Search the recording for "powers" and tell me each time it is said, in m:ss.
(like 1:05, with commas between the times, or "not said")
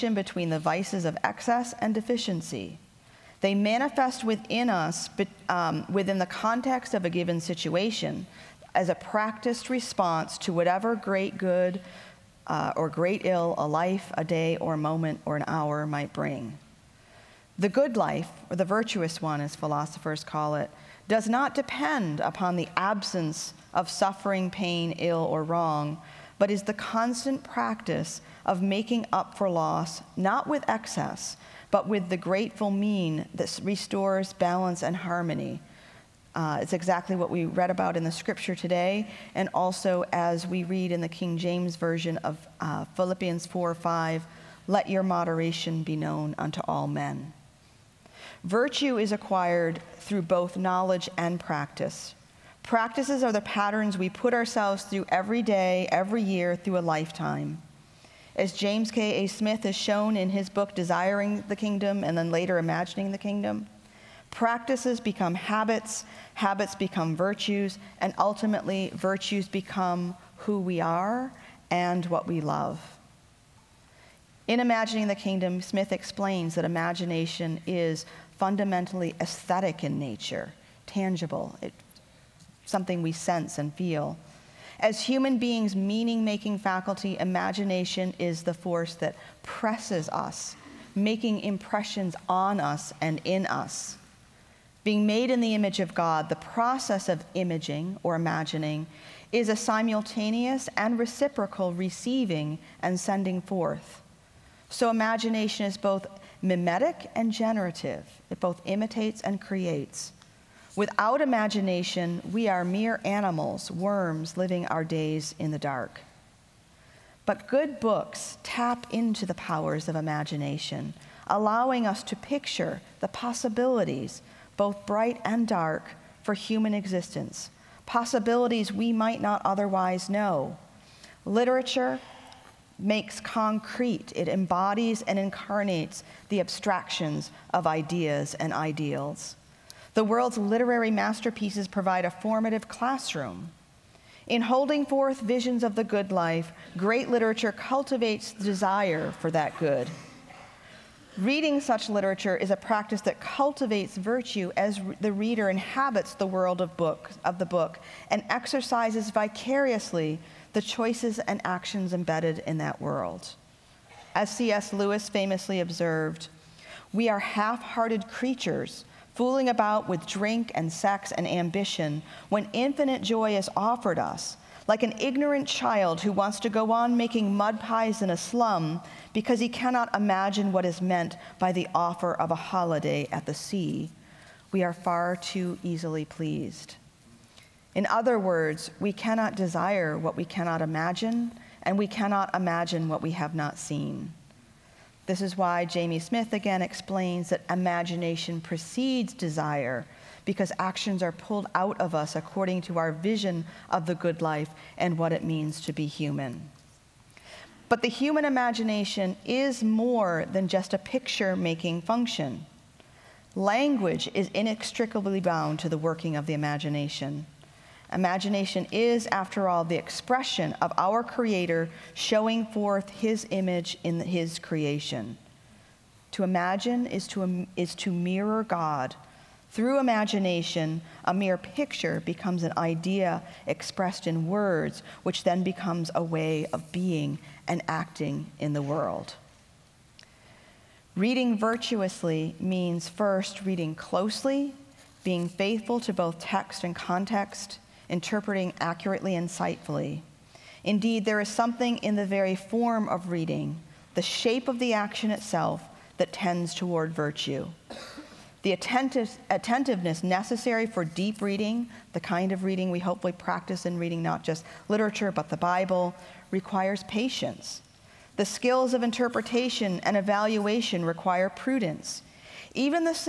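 1:59.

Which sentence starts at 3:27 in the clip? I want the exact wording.
But the human imagination is more than just a picture making function.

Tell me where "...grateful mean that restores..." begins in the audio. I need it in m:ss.
0:32.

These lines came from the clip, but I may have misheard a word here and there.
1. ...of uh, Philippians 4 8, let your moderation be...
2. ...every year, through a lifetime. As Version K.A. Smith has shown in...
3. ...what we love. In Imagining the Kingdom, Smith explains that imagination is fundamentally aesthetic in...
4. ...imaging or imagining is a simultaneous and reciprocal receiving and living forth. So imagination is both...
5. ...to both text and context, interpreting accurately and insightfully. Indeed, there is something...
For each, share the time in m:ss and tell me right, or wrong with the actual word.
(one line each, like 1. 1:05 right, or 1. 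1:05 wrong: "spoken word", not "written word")
1. 0:42 wrong: "5", not "8"
2. 0:55 wrong: "James", not "Version"
3. 1:12 right
4. 1:37 wrong: "sending", not "living"
5. 4:05 right.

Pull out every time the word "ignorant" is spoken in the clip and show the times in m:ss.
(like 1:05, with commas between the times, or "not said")
2:54.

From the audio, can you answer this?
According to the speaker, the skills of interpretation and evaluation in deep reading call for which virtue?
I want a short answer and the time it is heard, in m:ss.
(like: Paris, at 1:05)
Prudence, at 4:31.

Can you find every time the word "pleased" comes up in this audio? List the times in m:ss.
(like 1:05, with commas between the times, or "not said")
3:06.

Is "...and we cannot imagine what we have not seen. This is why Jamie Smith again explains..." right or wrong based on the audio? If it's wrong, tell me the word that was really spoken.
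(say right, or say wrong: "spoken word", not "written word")
right.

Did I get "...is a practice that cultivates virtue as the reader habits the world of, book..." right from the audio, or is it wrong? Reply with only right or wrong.
wrong.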